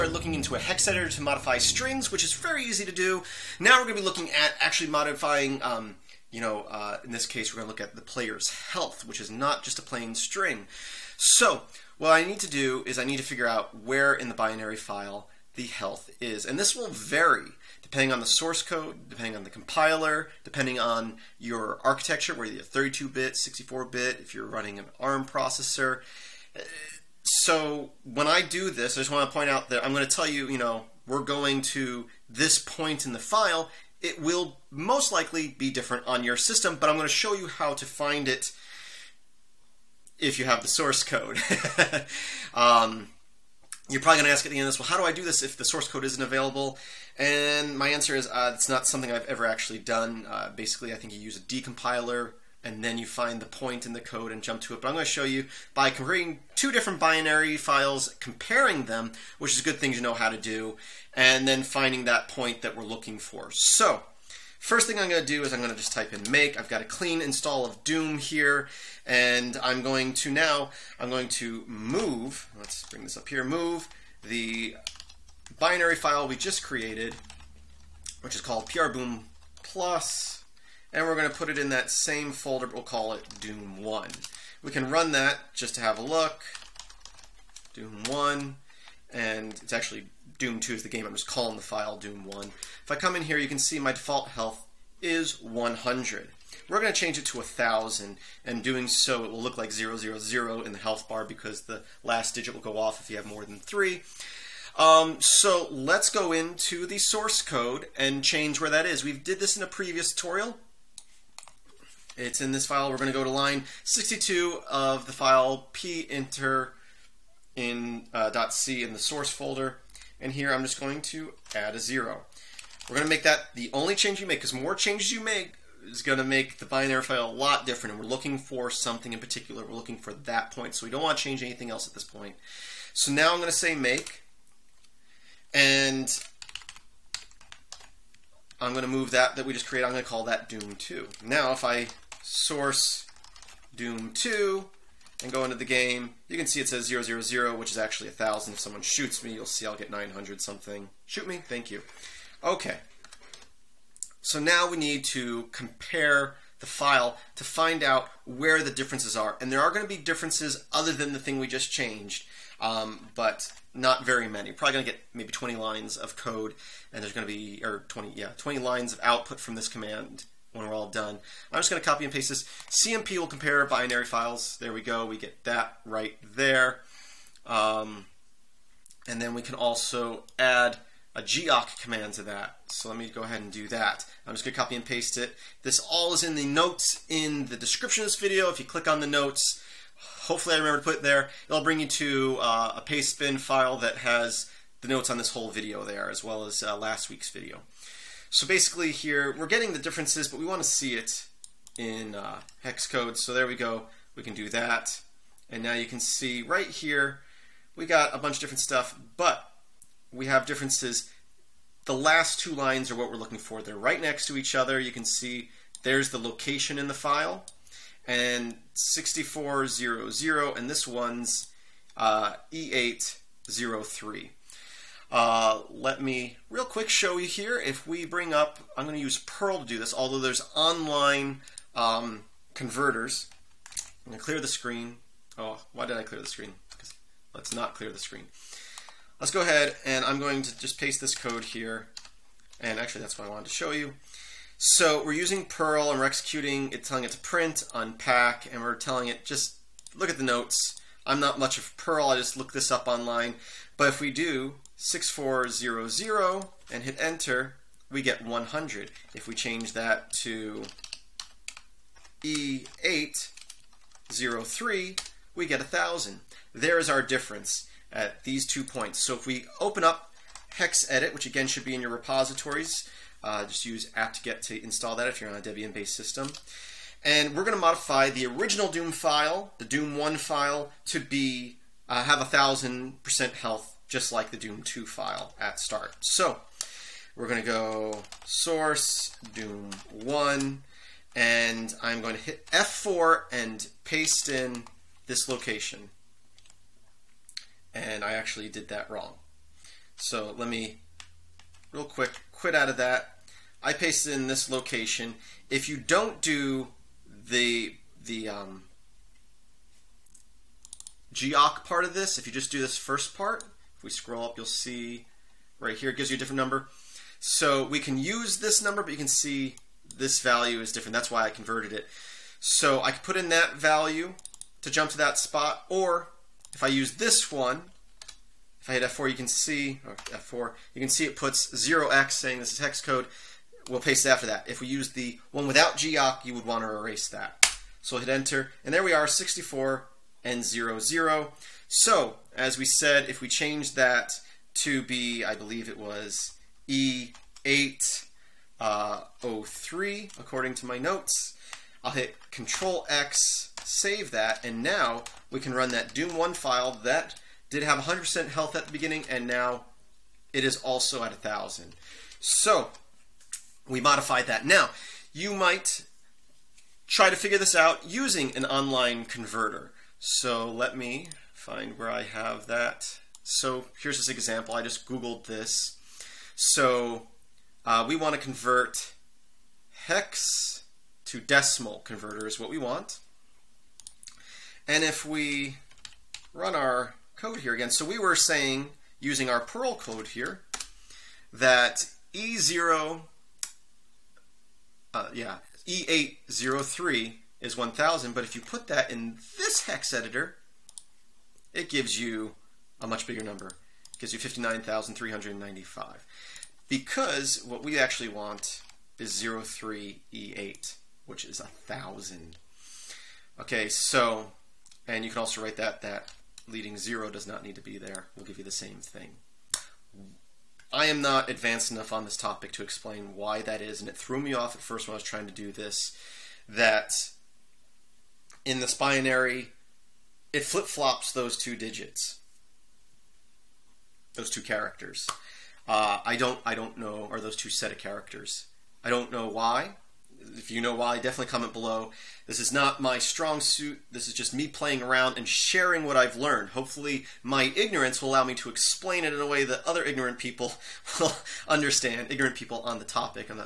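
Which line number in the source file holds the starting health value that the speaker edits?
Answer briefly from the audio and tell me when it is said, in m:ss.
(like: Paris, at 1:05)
62, at 1:53.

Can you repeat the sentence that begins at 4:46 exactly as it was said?
So we're going to go source, Doom 1, and I'm going to hit F4 and paste in this location.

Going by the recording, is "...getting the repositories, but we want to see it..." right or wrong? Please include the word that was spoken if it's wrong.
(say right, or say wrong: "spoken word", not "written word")
wrong: "differences", not "repositories".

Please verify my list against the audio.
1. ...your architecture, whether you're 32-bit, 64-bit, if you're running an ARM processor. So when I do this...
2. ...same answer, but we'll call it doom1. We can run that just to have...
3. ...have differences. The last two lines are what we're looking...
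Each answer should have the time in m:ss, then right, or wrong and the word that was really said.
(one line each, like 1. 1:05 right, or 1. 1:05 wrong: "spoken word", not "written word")
1. 0:21 right
2. 1:21 wrong: "folder", not "answer"
3. 3:30 right.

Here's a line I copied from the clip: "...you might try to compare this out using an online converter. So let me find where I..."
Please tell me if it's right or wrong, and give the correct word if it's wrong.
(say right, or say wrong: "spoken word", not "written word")
wrong: "figure", not "compare".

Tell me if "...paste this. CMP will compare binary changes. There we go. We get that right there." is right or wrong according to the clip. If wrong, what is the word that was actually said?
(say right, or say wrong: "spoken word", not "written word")
wrong: "files", not "changes".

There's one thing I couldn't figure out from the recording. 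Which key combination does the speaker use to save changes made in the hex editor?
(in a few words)
Control X.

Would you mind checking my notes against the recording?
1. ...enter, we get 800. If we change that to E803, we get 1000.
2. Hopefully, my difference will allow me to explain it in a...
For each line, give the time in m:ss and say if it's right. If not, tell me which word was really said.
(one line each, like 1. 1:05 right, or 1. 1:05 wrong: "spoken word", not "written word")
1. 4:17 wrong: "100", not "800"
2. 7:26 wrong: "ignorance", not "difference".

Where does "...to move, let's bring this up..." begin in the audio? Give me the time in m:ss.
1:11.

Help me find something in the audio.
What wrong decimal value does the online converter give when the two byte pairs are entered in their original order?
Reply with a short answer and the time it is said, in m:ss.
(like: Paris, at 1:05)
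59,395, at 6:44.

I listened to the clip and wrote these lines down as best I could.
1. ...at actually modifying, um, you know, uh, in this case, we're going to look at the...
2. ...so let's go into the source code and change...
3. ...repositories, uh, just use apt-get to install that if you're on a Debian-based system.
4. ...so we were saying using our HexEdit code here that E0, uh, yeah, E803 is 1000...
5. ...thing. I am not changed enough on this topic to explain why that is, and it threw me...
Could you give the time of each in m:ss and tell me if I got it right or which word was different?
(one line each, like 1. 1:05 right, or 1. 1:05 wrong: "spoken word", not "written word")
1. 0:04 right
2. 1:45 right
3. 4:31 right
4. 6:27 wrong: "Perl", not "HexEdit"
5. 6:58 wrong: "advanced", not "changed".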